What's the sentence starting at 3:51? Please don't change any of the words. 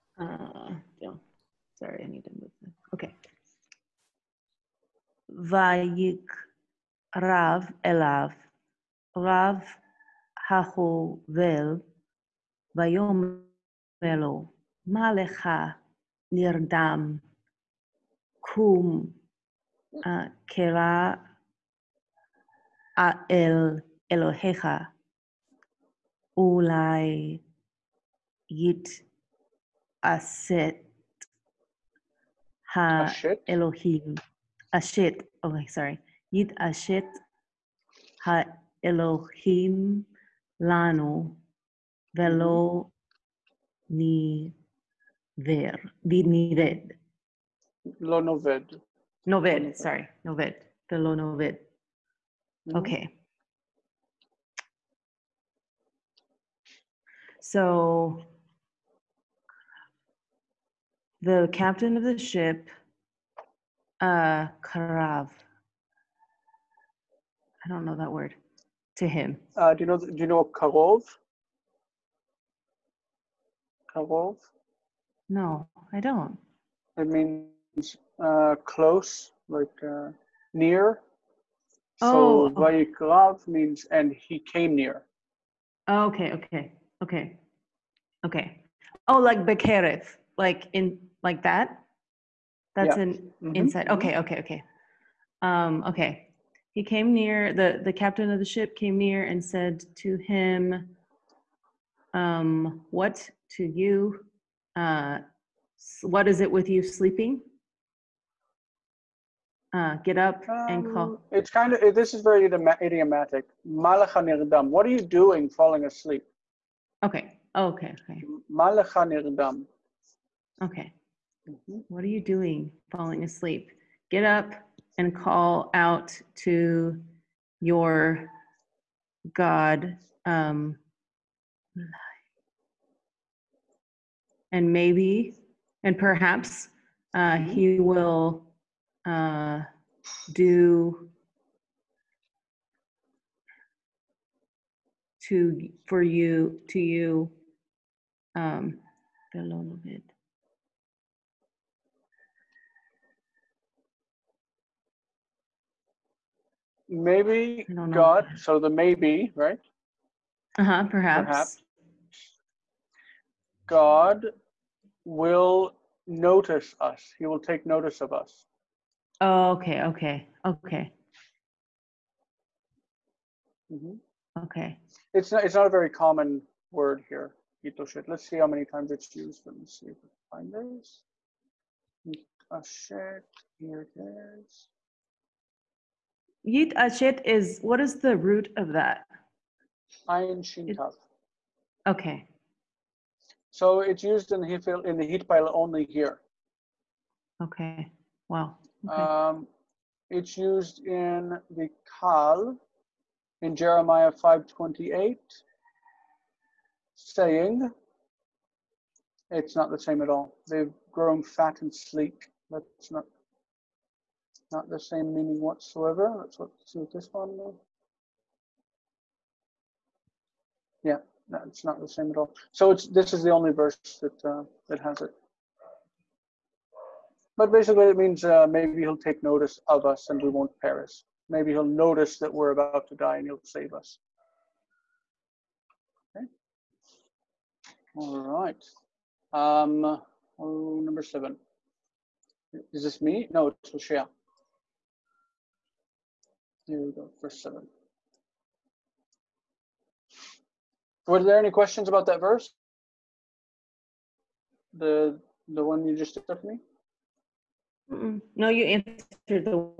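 Maybe he'll notice that we're about to die and he'll save us.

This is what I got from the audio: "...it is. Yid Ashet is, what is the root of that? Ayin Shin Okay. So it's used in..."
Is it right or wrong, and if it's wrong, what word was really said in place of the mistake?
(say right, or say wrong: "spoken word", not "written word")
right.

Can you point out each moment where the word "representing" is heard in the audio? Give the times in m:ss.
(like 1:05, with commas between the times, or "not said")
not said.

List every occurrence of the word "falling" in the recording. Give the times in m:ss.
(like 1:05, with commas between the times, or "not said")
1:55, 2:02.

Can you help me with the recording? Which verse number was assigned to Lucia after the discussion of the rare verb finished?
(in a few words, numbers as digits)
7.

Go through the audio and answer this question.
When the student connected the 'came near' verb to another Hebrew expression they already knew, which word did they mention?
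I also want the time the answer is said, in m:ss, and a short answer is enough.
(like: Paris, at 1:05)
Bekerev, at 1:29.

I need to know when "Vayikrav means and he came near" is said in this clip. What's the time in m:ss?
1:22.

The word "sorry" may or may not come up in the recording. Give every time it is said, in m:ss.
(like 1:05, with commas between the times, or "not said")
0:01, 0:35, 0:49.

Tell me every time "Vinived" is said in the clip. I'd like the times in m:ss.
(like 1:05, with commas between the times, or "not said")
0:46.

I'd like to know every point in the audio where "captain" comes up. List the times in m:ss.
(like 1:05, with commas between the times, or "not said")
1:01, 1:37.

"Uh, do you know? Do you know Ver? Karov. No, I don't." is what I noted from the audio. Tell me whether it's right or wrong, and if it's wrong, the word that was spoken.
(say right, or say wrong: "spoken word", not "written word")
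wrong: "Karov", not "Ver".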